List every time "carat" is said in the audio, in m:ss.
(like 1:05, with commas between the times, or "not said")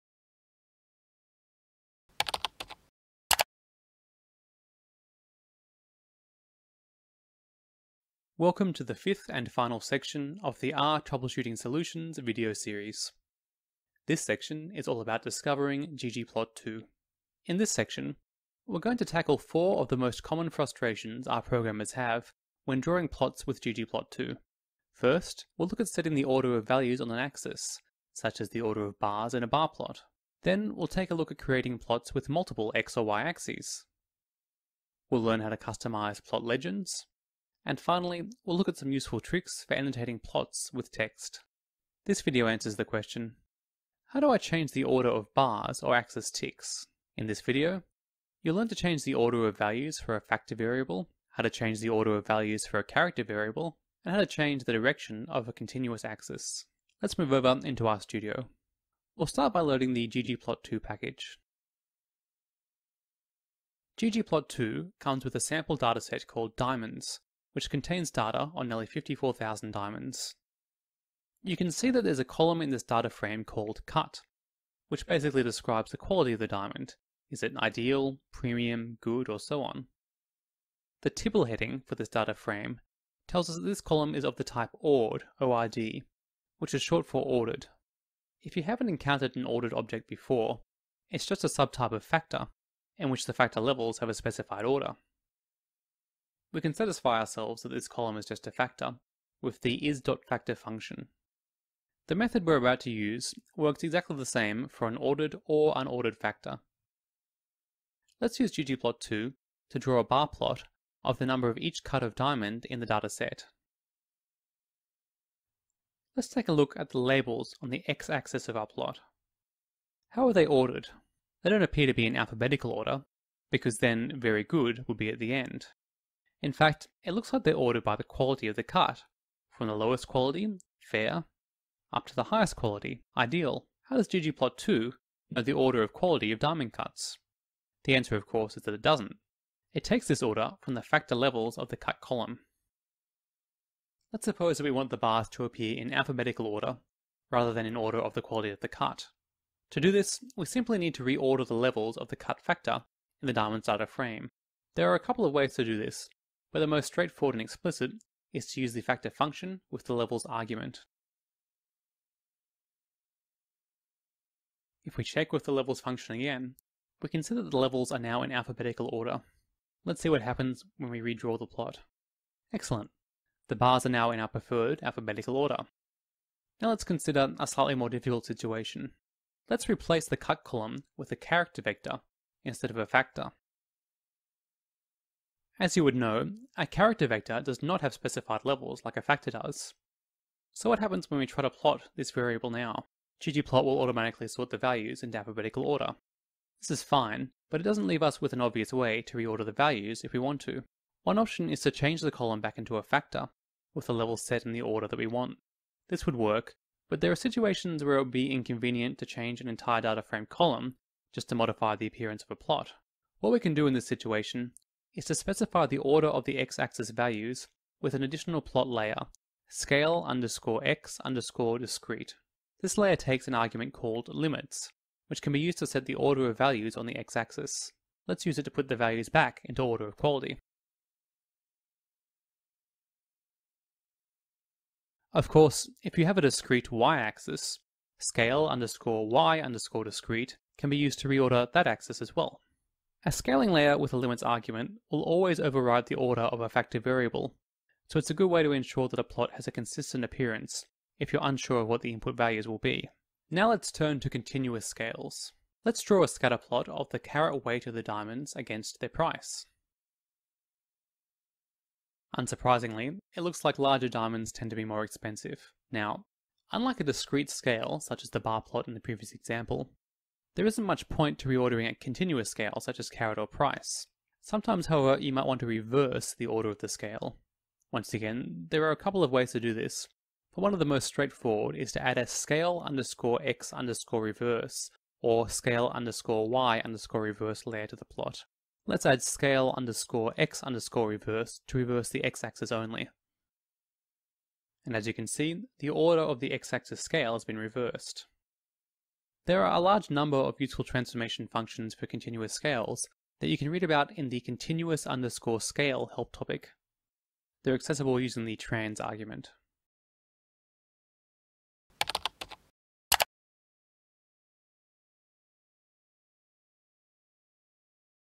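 4:16, 4:32.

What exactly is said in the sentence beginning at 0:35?
We'll learn how to customize plot legends, and finally, we'll look at some useful tricks for annotating plots with text.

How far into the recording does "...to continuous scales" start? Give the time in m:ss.
4:14.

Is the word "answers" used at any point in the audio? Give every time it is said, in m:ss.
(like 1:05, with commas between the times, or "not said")
0:42, 2:17.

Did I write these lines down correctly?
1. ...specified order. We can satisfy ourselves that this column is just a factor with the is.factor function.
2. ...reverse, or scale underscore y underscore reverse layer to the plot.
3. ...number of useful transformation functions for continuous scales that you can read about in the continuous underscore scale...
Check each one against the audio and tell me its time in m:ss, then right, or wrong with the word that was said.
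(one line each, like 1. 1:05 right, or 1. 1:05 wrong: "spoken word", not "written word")
1. 1:34 right
2. 4:44 right
3. 4:59 right.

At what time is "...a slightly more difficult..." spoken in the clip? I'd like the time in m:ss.
2:57.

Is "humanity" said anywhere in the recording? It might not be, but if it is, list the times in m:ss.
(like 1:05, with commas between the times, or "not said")
not said.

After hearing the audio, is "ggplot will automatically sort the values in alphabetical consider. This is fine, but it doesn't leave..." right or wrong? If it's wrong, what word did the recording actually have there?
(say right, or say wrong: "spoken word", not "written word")
wrong: "order", not "consider".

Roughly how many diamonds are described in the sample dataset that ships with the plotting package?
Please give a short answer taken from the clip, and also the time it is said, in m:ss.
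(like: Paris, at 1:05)
nearly 54,000, at 1:08.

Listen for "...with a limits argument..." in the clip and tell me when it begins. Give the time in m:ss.
4:03.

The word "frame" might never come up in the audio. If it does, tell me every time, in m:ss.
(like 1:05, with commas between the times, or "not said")
1:13, 1:22, 2:33, 3:30.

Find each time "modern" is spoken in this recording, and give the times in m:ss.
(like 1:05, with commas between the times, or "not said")
not said.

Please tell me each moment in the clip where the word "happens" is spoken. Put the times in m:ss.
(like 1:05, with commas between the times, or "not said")
2:50, 3:10.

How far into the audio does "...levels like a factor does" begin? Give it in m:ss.
3:08.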